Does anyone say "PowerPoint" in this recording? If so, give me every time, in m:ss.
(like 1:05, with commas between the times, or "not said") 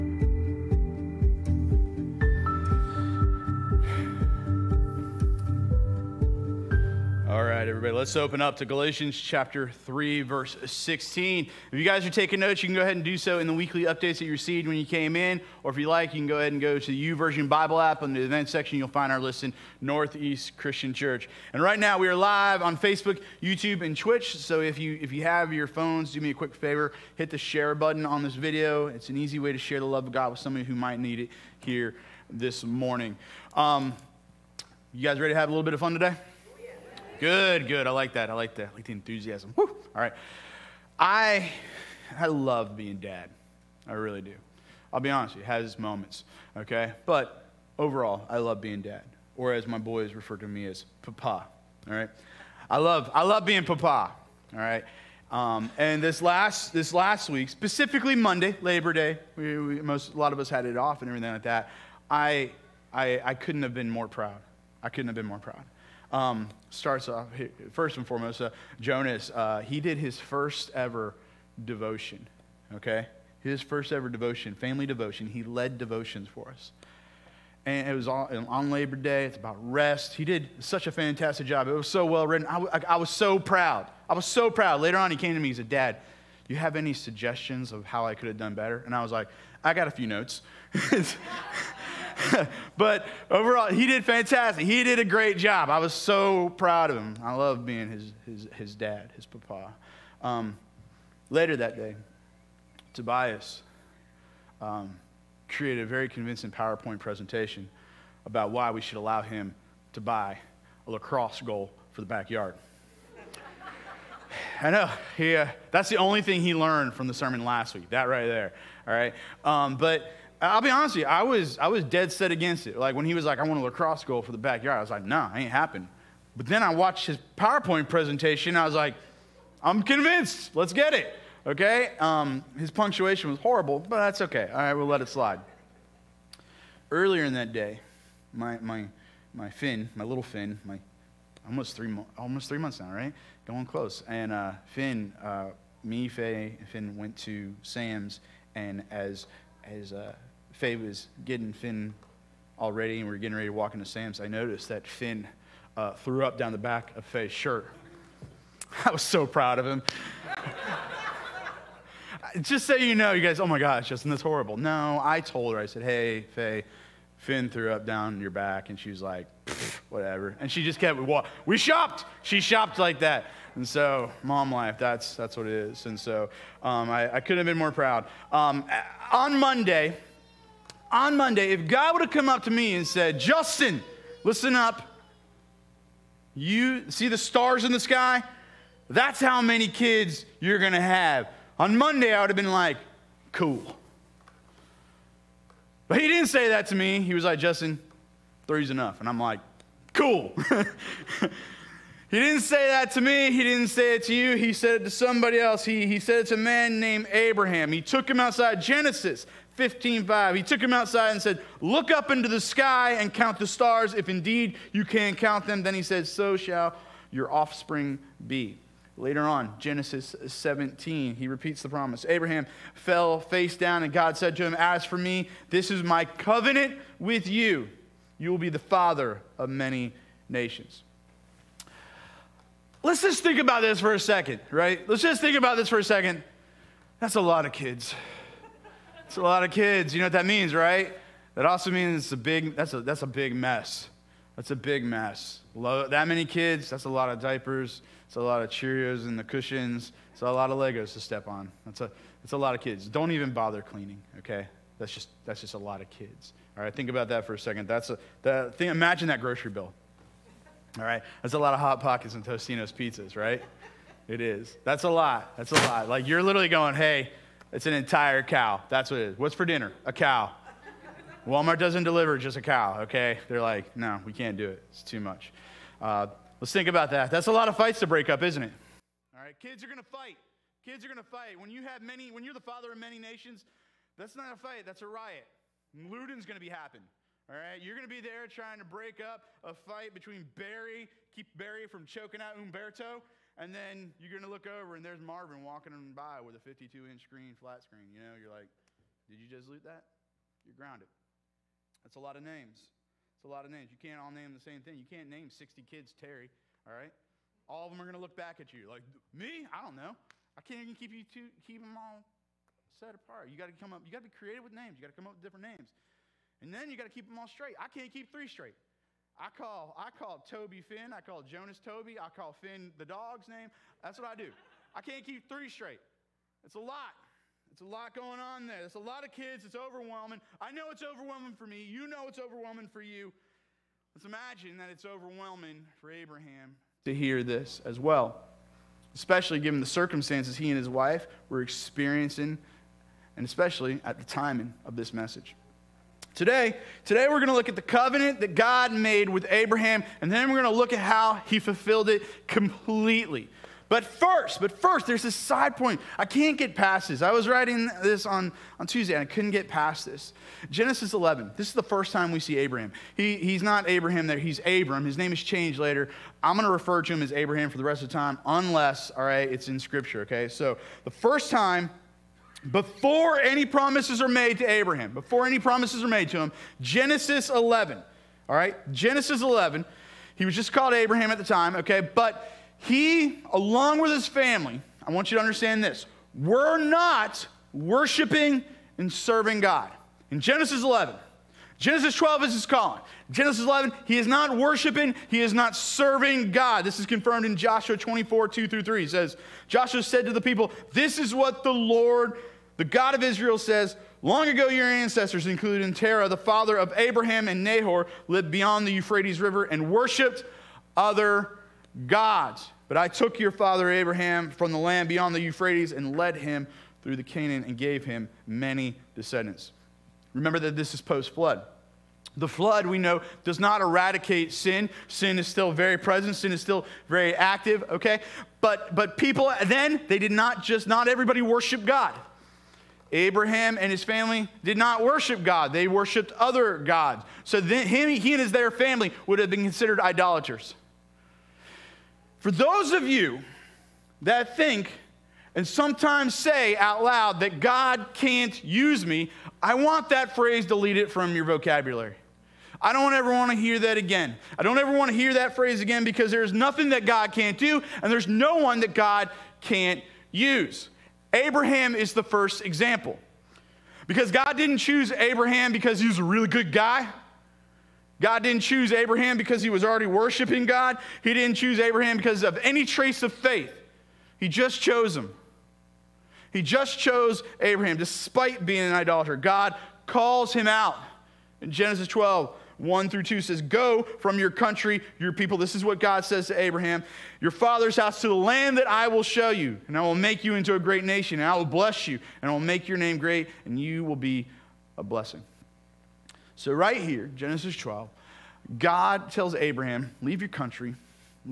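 1:46, 2:07.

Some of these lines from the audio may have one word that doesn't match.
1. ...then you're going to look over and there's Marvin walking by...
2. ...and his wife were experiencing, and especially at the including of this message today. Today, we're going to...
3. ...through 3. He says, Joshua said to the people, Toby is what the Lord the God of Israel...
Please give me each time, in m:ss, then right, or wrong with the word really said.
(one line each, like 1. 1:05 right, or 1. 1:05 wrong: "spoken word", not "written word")
1. 4:53 right
2. 5:40 wrong: "timing", not "including"
3. 6:38 wrong: "This", not "Toby".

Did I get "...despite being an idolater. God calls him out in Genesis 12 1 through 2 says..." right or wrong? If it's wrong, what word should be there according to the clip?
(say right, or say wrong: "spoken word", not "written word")
right.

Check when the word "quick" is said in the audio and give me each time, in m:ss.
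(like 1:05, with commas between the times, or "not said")
0:26.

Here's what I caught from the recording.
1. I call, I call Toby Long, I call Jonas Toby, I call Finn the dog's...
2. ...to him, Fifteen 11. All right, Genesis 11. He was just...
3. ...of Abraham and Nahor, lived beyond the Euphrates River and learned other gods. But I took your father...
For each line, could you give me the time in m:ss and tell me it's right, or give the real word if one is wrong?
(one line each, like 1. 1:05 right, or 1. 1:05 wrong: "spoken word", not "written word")
1. 5:19 wrong: "Finn", not "Long"
2. 6:16 wrong: "Genesis", not "Fifteen"
3. 6:46 wrong: "worshiped", not "learned".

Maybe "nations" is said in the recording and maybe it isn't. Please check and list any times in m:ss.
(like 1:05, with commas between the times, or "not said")
3:50, 4:42, 8:10.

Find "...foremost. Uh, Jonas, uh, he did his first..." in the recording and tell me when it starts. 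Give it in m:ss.
1:08.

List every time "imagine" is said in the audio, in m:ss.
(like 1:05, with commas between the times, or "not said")
4:18, 5:34.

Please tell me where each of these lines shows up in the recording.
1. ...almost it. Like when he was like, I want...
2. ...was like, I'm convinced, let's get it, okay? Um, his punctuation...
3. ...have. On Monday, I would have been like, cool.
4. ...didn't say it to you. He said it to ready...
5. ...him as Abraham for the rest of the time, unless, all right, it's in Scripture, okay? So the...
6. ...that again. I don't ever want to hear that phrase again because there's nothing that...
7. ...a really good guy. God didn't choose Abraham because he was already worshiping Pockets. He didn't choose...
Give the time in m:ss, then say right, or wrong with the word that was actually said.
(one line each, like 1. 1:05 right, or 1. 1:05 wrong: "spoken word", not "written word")
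1. 2:02 wrong: "against", not "almost"
2. 2:08 right
3. 3:10 right
4. 3:23 wrong: "somebody", not "ready"
5. 6:06 right
6. 7:33 right
7. 7:45 wrong: "God", not "Pockets".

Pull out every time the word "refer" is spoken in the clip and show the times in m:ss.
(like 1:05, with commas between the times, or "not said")
0:50, 6:06.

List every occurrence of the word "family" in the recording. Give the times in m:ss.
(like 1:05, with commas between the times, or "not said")
1:14, 6:24, 7:13, 7:18.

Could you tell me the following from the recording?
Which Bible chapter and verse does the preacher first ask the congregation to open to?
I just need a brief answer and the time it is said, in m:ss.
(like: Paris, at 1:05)
Galatians 3:16, at 0:08.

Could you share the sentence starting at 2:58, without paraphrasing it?
Um, on Monday, on Monday, if God would have come up to me and said, Justin, listen up.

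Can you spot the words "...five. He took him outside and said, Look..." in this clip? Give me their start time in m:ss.
3:30.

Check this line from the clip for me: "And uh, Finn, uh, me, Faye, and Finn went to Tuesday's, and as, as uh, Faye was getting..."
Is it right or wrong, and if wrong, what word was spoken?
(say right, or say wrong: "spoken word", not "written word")
wrong: "Sam", not "Tuesday".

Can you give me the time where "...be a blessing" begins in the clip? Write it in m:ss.
8:13.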